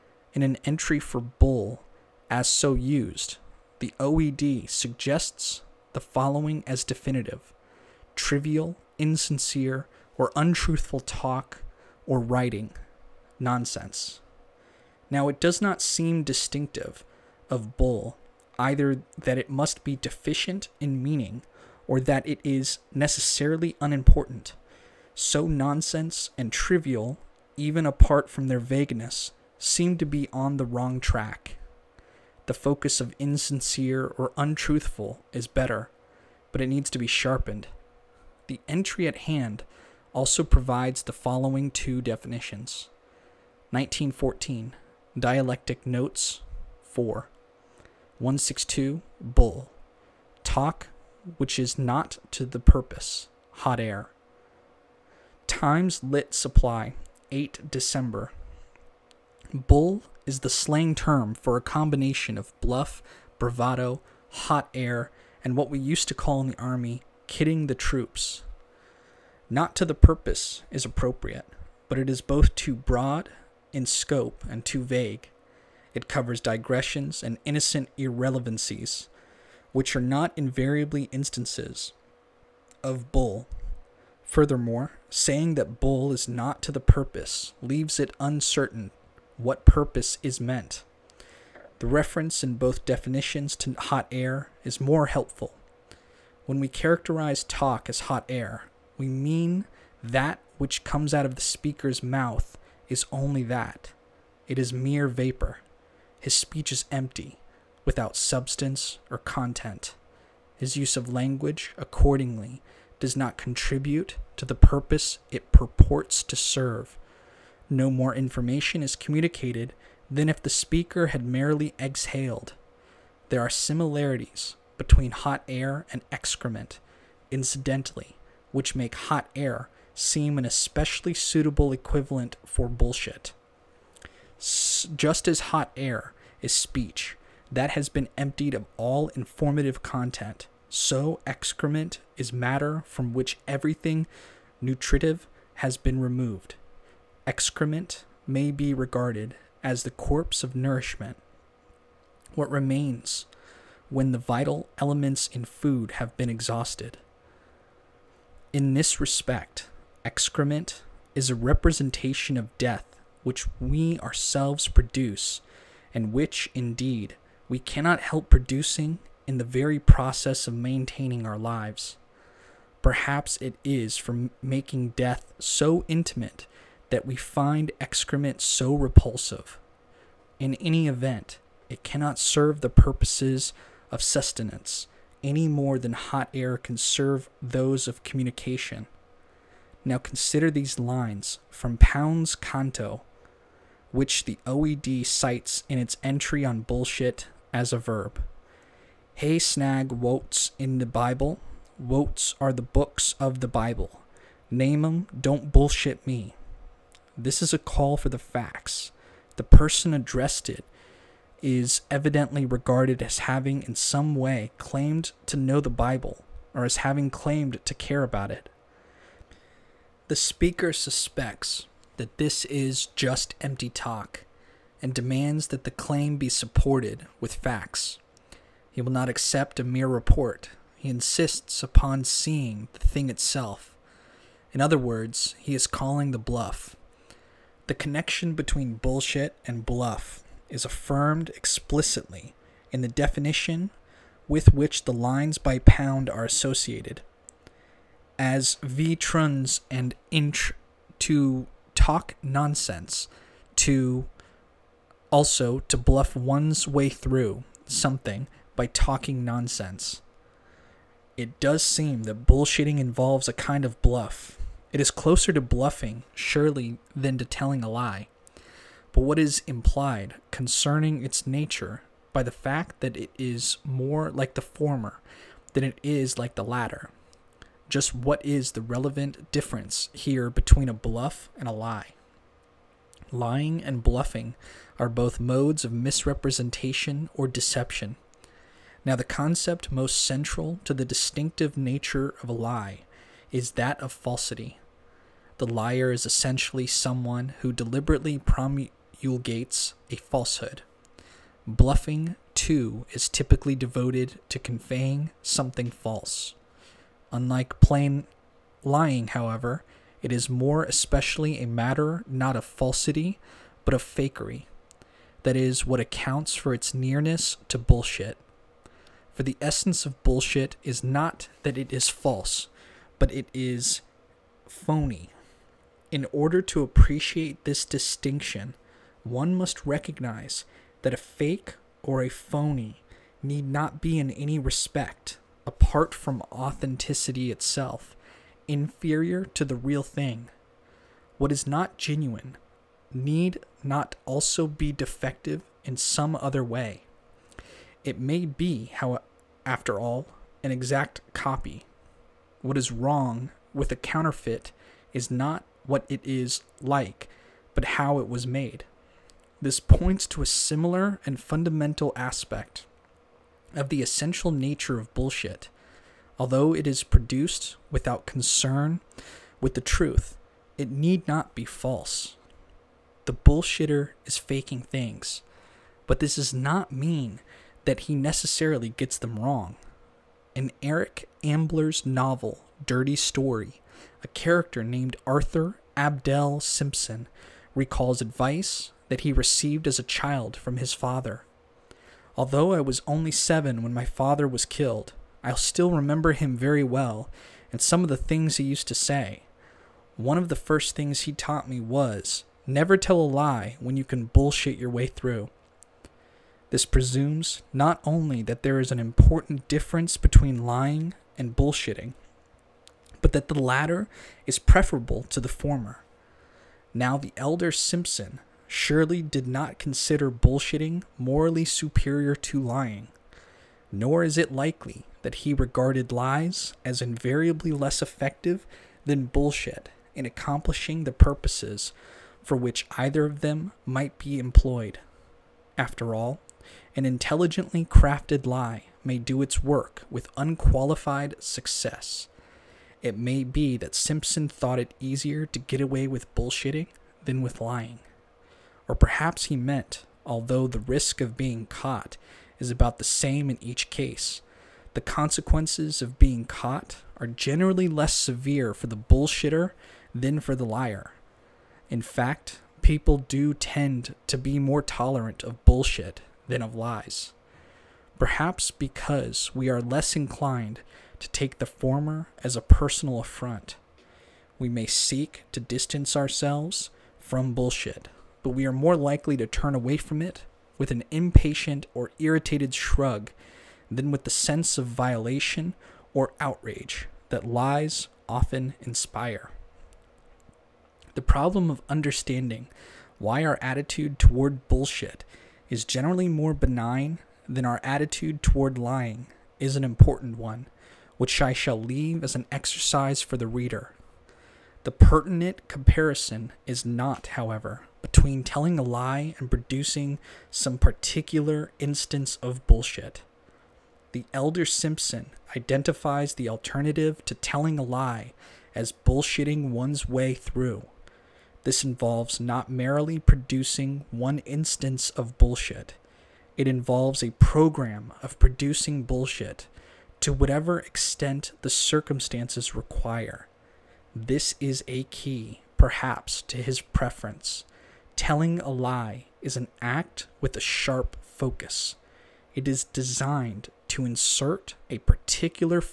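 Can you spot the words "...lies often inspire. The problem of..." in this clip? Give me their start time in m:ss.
8:07.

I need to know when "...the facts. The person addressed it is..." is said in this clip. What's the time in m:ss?
3:28.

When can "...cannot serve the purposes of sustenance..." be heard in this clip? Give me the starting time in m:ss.
3:01.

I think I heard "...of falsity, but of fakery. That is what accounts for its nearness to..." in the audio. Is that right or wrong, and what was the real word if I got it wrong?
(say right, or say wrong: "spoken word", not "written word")
right.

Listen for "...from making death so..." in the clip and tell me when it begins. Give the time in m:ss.
2:53.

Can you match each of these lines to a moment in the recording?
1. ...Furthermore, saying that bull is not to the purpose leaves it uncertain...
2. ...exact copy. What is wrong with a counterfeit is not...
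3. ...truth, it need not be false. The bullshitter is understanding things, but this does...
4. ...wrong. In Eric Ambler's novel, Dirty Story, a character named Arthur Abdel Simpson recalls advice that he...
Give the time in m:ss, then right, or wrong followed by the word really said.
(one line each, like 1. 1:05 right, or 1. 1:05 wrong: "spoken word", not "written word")
1. 1:24 right
2. 5:50 right
3. 6:09 wrong: "faking", not "understanding"
4. 6:19 right.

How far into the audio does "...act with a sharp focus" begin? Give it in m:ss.
8:59.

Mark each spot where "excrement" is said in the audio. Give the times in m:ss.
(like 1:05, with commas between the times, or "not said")
2:06, 2:21, 2:27, 2:40, 2:57.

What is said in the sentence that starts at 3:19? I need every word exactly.
Hey snag wotes in the Bible.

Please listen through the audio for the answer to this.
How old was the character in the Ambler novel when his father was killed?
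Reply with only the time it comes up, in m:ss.
6:33.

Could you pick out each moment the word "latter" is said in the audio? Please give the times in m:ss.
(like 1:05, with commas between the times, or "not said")
4:36, 6:53.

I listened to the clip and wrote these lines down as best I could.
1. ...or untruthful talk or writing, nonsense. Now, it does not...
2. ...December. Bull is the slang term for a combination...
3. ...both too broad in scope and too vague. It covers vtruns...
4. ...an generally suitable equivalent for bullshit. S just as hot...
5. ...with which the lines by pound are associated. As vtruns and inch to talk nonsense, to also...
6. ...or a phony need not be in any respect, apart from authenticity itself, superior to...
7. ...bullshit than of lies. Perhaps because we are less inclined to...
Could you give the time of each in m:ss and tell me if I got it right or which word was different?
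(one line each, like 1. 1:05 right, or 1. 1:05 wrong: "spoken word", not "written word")
1. 0:10 right
2. 0:57 right
3. 1:12 wrong: "digressions", not "vtruns"
4. 2:10 wrong: "especially", not "generally"
5. 4:04 right
6. 5:31 wrong: "inferior", not "superior"
7. 7:45 right.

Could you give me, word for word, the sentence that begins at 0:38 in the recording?
The entry at hand also provides the following two definitions 1914, Dialectic Notes, 4.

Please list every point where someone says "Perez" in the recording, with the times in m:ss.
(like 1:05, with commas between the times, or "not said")
not said.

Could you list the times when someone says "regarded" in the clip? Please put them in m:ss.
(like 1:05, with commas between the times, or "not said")
2:28, 3:32, 7:05.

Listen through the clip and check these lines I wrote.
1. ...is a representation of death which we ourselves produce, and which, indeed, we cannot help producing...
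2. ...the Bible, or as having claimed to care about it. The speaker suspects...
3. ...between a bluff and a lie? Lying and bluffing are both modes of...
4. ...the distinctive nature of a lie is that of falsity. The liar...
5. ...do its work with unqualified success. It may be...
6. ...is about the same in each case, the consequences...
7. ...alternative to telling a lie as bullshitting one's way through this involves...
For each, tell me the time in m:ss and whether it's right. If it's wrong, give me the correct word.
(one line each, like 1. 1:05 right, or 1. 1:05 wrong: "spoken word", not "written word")
1. 2:41 right
2. 3:35 right
3. 4:40 right
4. 4:50 right
5. 7:18 right
6. 7:32 right
7. 8:36 right.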